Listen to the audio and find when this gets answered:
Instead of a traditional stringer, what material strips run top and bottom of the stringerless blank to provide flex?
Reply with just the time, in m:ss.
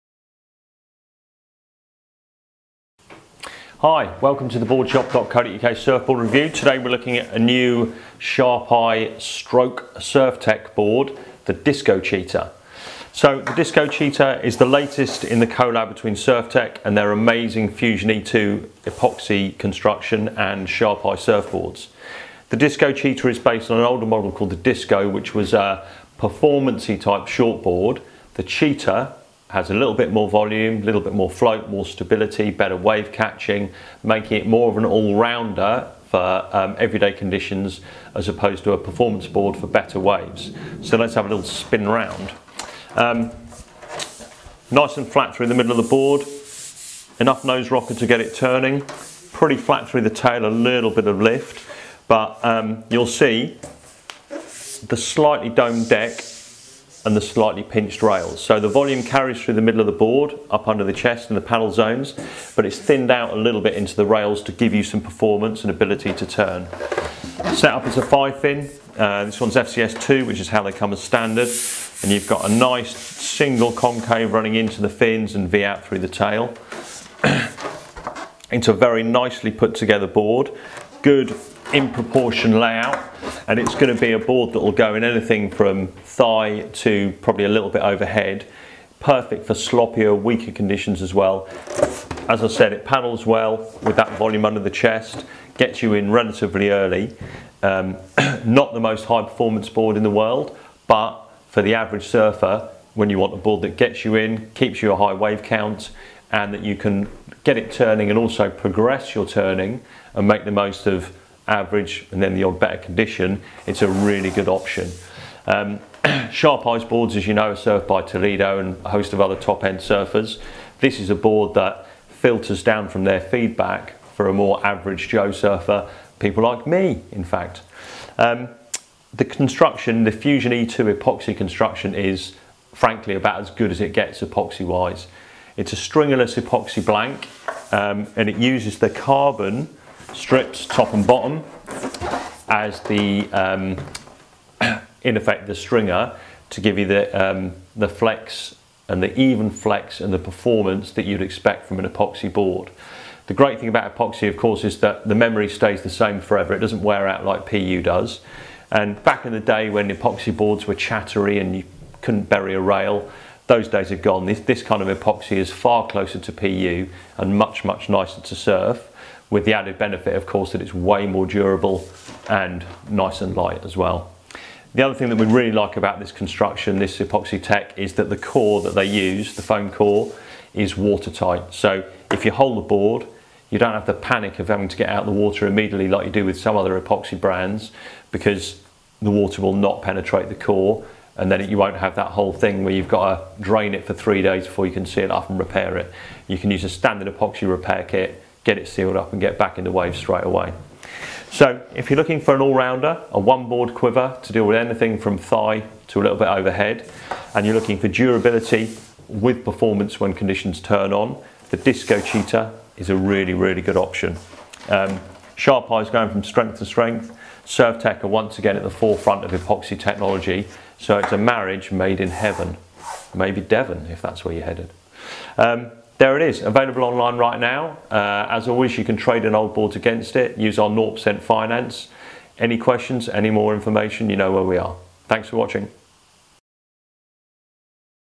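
2:18.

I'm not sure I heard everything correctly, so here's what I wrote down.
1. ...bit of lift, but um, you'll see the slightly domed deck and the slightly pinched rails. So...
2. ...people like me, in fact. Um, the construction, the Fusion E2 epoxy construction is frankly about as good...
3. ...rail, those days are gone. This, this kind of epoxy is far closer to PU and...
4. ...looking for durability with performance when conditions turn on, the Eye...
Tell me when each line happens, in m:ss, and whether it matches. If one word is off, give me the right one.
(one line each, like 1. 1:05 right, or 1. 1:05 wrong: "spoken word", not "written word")
1. 0:50 right
2. 2:06 right
3. 2:42 right
4. 3:27 wrong: "Disco", not "Eye".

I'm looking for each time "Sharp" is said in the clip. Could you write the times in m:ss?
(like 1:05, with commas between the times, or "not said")
0:08, 0:20, 1:56, 3:35.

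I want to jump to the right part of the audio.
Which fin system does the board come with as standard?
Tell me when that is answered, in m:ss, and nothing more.
1:09.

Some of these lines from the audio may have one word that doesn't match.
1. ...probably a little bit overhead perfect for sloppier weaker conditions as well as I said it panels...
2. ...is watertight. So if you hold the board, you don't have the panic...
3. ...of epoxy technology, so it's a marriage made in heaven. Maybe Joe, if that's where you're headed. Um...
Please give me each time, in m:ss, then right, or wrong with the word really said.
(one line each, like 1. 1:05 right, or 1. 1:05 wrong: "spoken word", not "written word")
1. 1:27 right
2. 3:00 right
3. 3:39 wrong: "Devon", not "Joe".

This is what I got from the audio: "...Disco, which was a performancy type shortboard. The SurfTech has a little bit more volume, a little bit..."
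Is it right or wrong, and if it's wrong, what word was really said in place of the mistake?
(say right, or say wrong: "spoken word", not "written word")
wrong: "Cheater", not "SurfTech".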